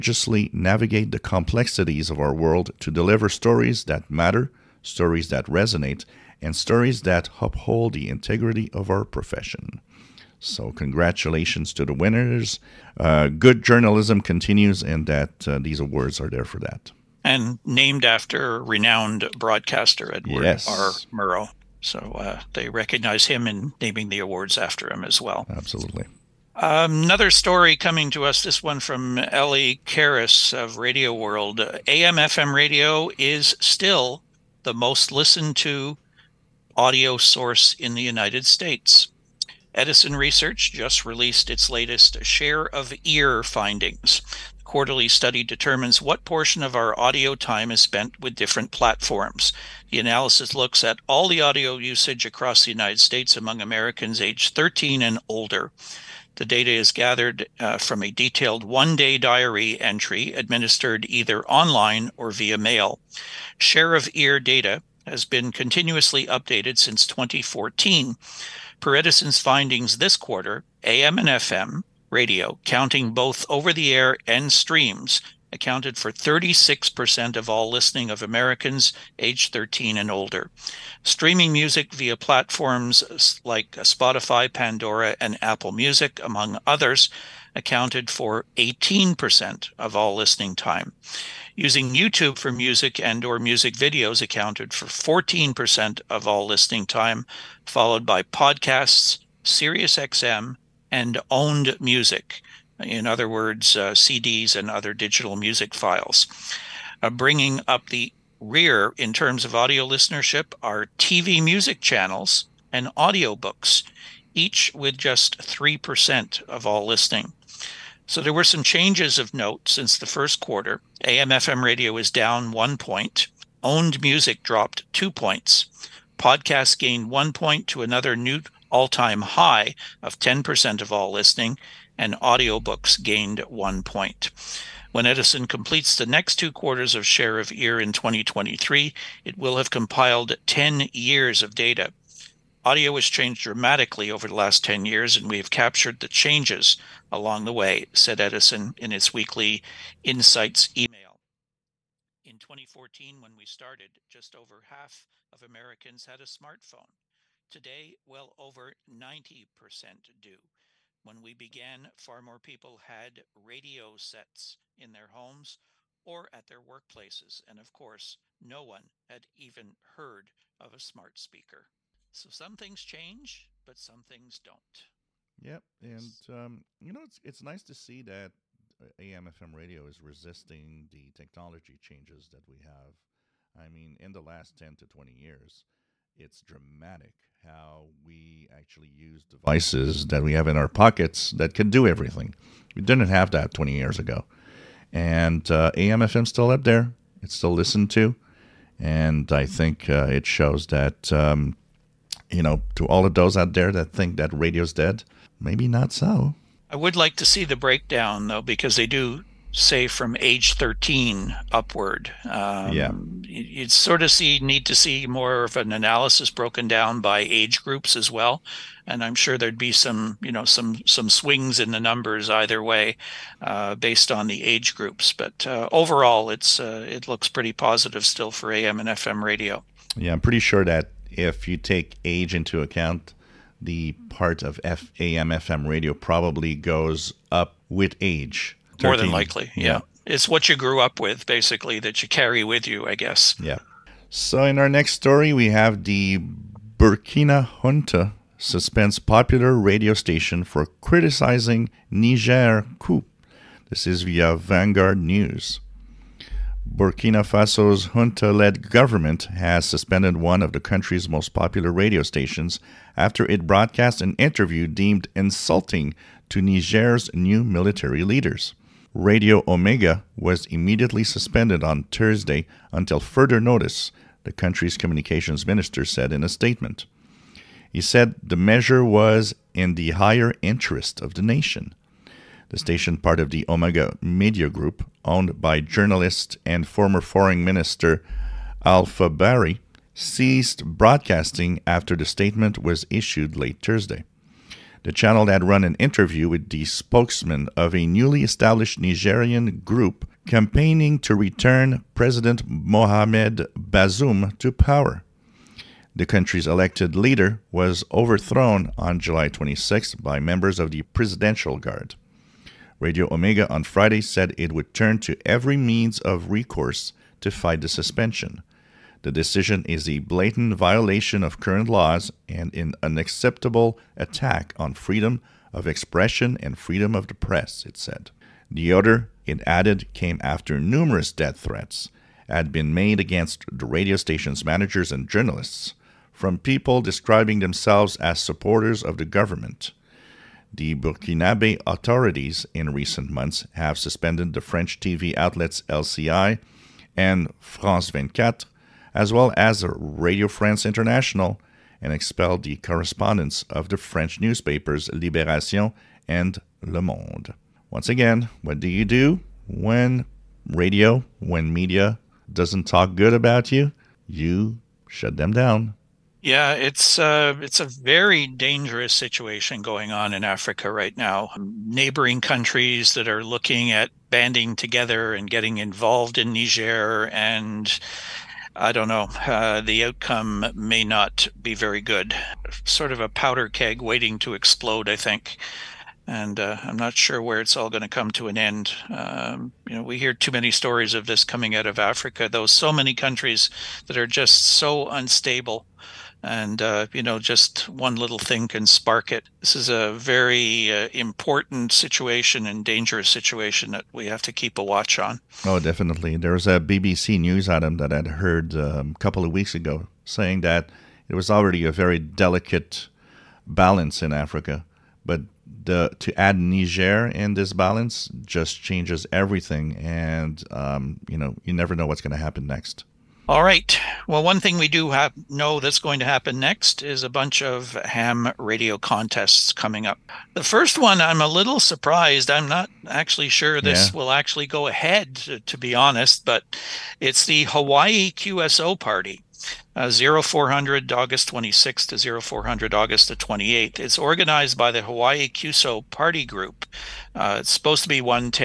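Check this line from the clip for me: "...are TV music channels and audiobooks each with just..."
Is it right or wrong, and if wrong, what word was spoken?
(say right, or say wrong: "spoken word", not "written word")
right.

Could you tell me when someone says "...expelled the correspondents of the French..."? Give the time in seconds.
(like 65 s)
351 s.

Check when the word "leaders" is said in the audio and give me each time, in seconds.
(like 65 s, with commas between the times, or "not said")
268 s, 306 s.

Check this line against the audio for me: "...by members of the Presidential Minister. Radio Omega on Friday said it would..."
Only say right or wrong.
wrong.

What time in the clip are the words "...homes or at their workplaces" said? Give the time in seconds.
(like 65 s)
165 s.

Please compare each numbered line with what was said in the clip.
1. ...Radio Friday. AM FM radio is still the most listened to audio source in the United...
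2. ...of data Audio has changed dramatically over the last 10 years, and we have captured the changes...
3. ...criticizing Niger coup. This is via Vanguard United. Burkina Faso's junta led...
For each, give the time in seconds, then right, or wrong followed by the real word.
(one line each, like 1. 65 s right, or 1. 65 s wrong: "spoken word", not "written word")
1. 30 s wrong: "World", not "Friday"
2. 141 s right
3. 250 s wrong: "News", not "United".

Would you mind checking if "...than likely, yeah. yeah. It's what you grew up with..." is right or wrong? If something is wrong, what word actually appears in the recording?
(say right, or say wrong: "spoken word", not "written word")
right.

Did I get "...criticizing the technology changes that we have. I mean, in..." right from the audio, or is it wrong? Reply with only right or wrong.
wrong.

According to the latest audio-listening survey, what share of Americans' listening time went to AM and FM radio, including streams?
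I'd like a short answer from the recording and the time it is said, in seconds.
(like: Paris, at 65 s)
36%, at 76 s.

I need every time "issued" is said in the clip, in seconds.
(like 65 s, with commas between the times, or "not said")
292 s.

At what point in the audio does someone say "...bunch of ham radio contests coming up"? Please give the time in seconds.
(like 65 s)
427 s.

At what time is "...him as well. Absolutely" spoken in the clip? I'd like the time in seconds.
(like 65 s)
24 s.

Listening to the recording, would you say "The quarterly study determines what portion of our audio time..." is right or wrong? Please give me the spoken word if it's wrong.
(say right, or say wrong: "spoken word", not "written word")
right.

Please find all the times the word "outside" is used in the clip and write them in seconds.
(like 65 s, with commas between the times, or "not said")
not said.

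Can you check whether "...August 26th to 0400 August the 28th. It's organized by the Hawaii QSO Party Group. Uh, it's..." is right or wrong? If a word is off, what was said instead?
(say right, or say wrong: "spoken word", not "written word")
right.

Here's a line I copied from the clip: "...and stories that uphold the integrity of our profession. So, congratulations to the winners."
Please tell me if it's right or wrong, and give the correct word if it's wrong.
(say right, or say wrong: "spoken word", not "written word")
right.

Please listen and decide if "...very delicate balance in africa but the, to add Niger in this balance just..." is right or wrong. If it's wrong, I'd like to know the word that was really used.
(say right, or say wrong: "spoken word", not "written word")
right.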